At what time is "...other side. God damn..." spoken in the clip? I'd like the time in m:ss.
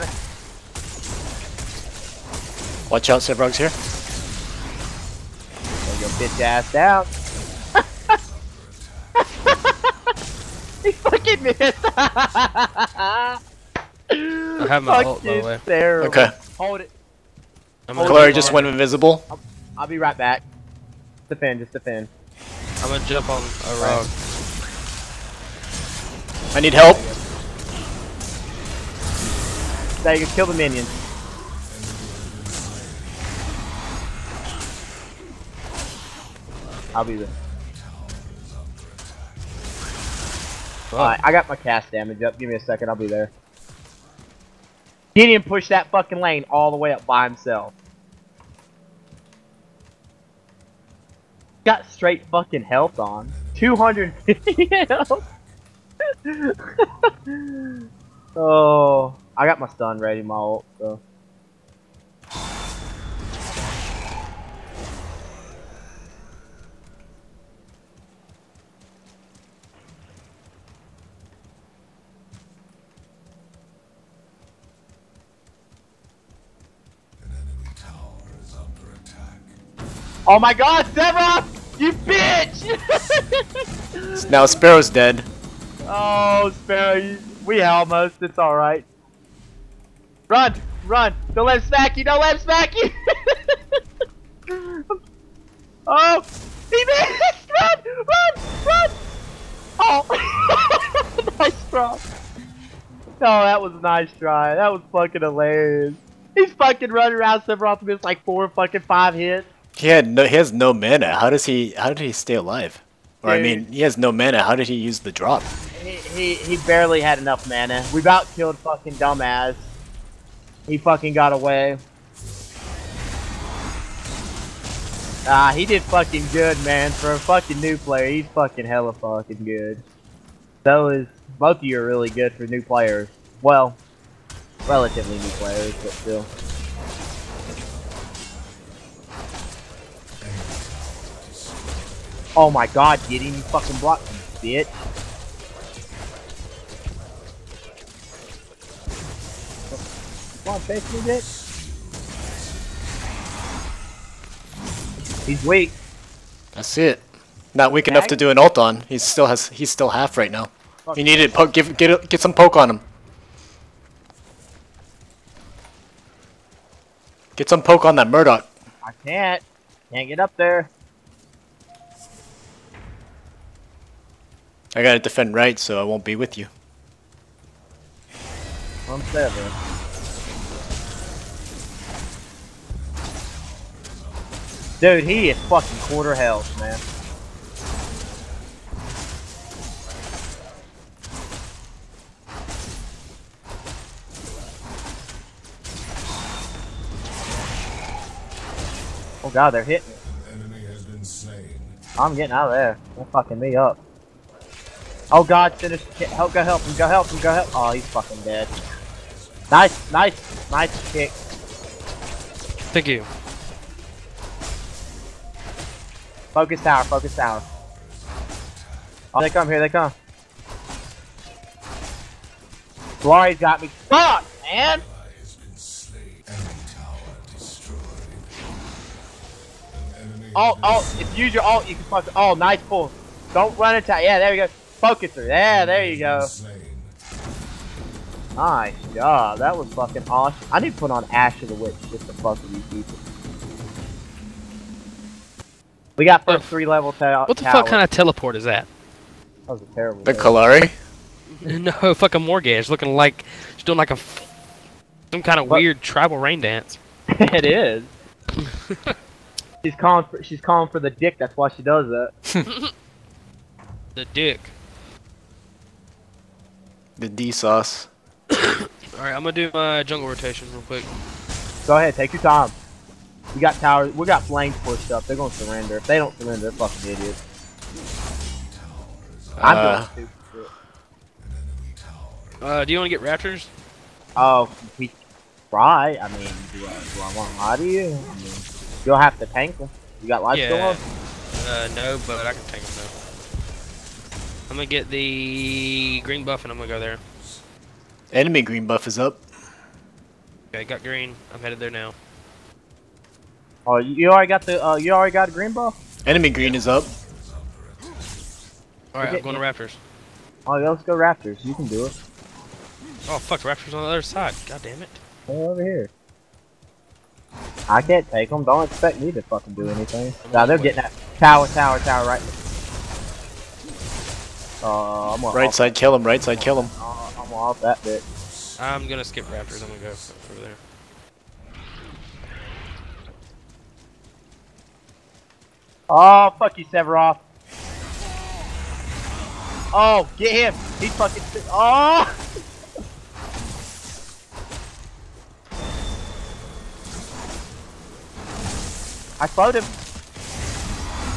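5:13.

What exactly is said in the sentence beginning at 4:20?
For, she's calling for the dick.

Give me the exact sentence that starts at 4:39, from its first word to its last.
I'm uh, doing Uh, do you wanna get raptors?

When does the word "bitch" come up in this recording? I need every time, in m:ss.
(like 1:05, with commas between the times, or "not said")
0:06, 1:21, 2:24, 2:31.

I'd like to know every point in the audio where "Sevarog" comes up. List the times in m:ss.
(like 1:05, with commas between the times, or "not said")
0:03, 1:20, 1:47, 5:36.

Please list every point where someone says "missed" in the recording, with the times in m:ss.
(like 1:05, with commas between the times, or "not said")
0:11, 1:36.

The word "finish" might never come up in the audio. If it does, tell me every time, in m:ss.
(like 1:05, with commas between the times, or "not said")
3:25.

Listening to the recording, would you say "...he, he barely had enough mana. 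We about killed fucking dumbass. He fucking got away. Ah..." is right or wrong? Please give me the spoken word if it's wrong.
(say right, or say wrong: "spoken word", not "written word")
right.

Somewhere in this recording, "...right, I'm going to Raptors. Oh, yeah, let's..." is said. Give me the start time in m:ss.
5:09.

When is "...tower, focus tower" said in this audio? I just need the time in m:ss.
3:36.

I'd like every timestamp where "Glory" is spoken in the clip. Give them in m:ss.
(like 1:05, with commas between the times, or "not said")
0:17, 3:43.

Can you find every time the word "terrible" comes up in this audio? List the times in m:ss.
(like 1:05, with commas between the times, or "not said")
0:15, 4:09.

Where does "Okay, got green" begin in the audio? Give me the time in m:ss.
5:00.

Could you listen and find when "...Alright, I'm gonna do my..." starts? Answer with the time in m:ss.
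4:28.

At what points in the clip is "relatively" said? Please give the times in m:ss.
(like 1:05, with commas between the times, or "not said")
2:14.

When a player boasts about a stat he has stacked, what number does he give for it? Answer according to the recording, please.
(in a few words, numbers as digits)
250.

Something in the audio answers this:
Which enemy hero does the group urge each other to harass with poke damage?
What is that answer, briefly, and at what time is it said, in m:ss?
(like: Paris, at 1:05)
Murdock, at 2:48.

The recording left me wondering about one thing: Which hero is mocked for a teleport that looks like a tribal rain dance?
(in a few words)
Morigesh.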